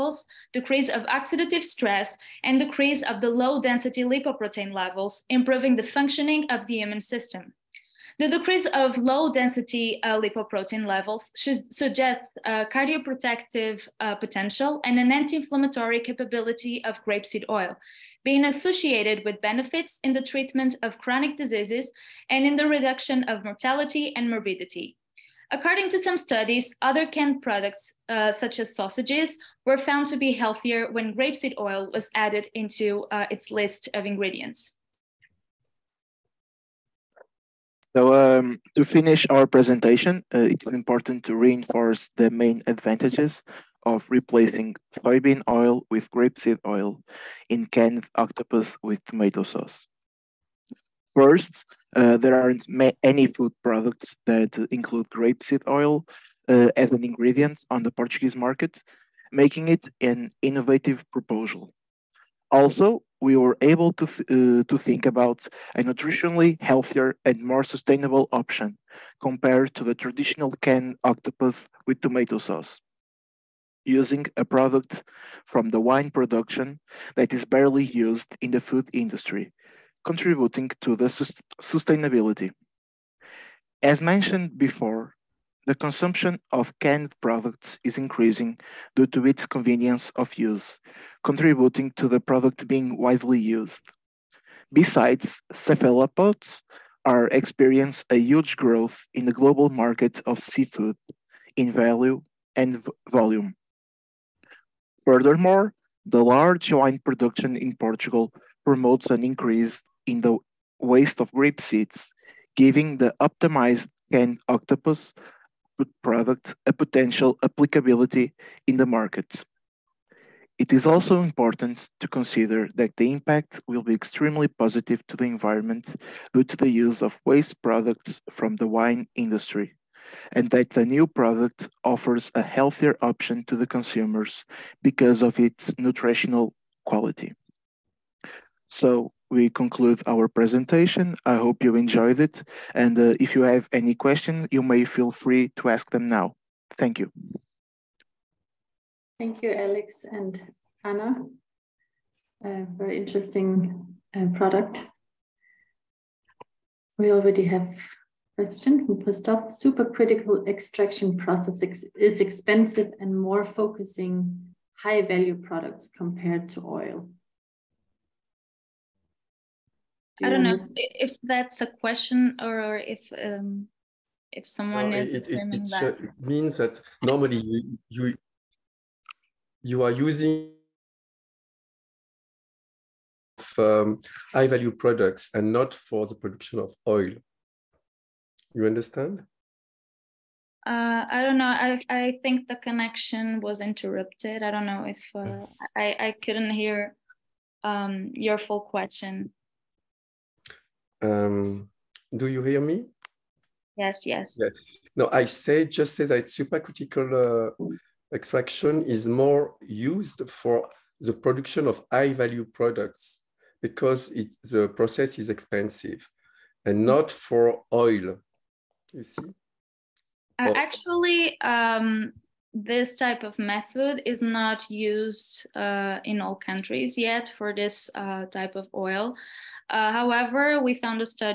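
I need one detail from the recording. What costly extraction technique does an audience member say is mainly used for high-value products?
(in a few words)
Supercritical extraction.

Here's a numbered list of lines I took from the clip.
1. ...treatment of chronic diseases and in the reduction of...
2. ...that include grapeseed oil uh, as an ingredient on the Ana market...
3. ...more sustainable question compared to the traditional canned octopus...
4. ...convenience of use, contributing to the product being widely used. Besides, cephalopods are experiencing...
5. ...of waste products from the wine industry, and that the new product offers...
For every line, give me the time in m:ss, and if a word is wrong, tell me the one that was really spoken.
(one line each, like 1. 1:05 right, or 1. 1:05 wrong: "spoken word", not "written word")
1. 0:20 right
2. 0:54 wrong: "Portuguese", not "Ana"
3. 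1:07 wrong: "option", not "question"
4. 1:29 right
5. 2:07 right.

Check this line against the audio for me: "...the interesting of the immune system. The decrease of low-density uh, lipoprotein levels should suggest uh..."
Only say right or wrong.
wrong.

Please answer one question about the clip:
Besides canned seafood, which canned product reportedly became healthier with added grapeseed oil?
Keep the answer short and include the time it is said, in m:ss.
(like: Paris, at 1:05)
Sausages, at 0:28.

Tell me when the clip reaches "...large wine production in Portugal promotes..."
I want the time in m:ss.
1:46.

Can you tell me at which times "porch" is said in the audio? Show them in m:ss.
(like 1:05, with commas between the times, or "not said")
not said.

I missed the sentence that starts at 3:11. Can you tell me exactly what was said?
I, I think the connection was interrupted.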